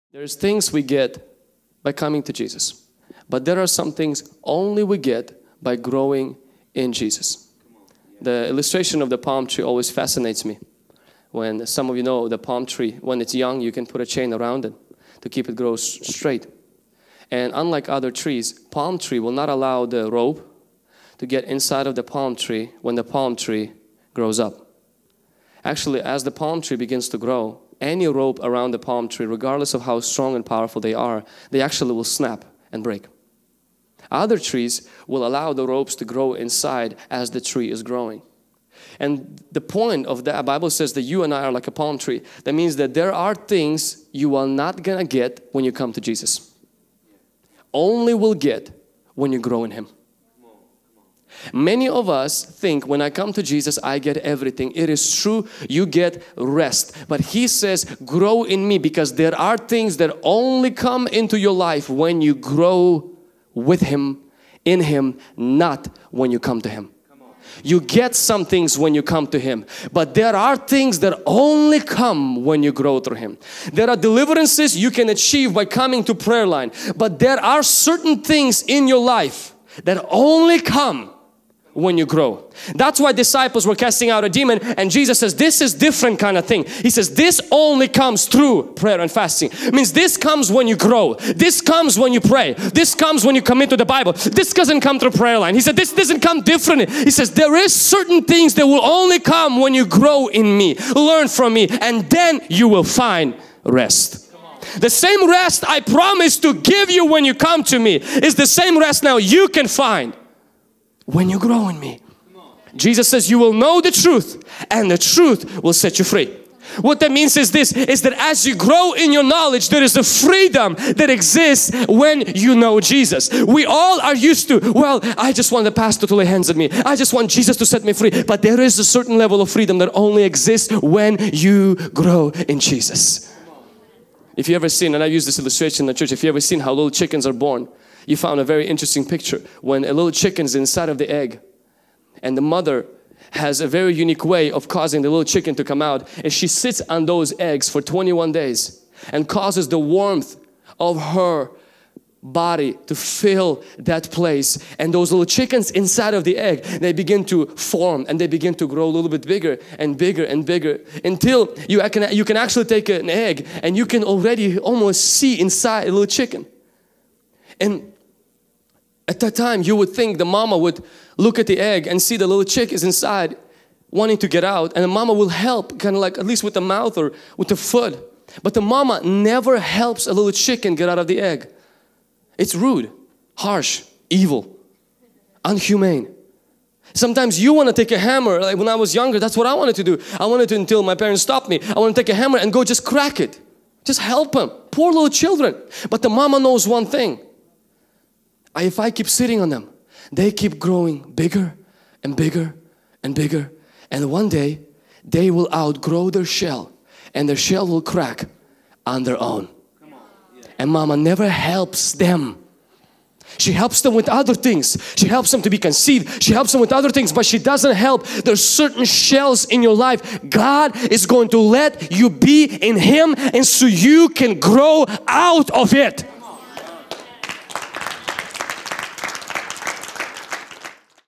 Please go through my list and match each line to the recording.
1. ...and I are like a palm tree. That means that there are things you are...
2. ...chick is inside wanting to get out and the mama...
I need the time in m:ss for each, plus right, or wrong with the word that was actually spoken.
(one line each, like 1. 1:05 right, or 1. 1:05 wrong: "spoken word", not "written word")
1. 0:41 right
2. 2:52 right.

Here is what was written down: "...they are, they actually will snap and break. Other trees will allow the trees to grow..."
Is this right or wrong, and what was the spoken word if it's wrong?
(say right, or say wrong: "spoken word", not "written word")
wrong: "ropes", not "trees".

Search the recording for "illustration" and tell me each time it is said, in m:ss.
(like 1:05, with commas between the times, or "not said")
0:08, 2:15.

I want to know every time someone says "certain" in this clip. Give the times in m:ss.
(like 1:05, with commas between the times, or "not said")
1:17, 1:37, 2:08, 3:38.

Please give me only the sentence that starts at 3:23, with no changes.
And one day, they will outgrow their shell and their shell will crack on their own.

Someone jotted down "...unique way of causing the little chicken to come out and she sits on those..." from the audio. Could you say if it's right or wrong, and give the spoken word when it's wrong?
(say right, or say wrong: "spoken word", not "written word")
right.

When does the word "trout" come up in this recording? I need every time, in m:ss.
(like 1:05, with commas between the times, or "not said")
not said.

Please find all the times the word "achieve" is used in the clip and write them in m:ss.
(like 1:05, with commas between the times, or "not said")
1:15.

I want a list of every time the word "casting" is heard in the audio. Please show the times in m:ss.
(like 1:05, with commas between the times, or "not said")
1:23.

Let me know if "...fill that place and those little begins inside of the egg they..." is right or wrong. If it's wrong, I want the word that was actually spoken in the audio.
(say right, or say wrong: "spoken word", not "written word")
wrong: "chickens", not "begins".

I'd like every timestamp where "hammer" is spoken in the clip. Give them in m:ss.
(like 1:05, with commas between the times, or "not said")
3:08, 3:12.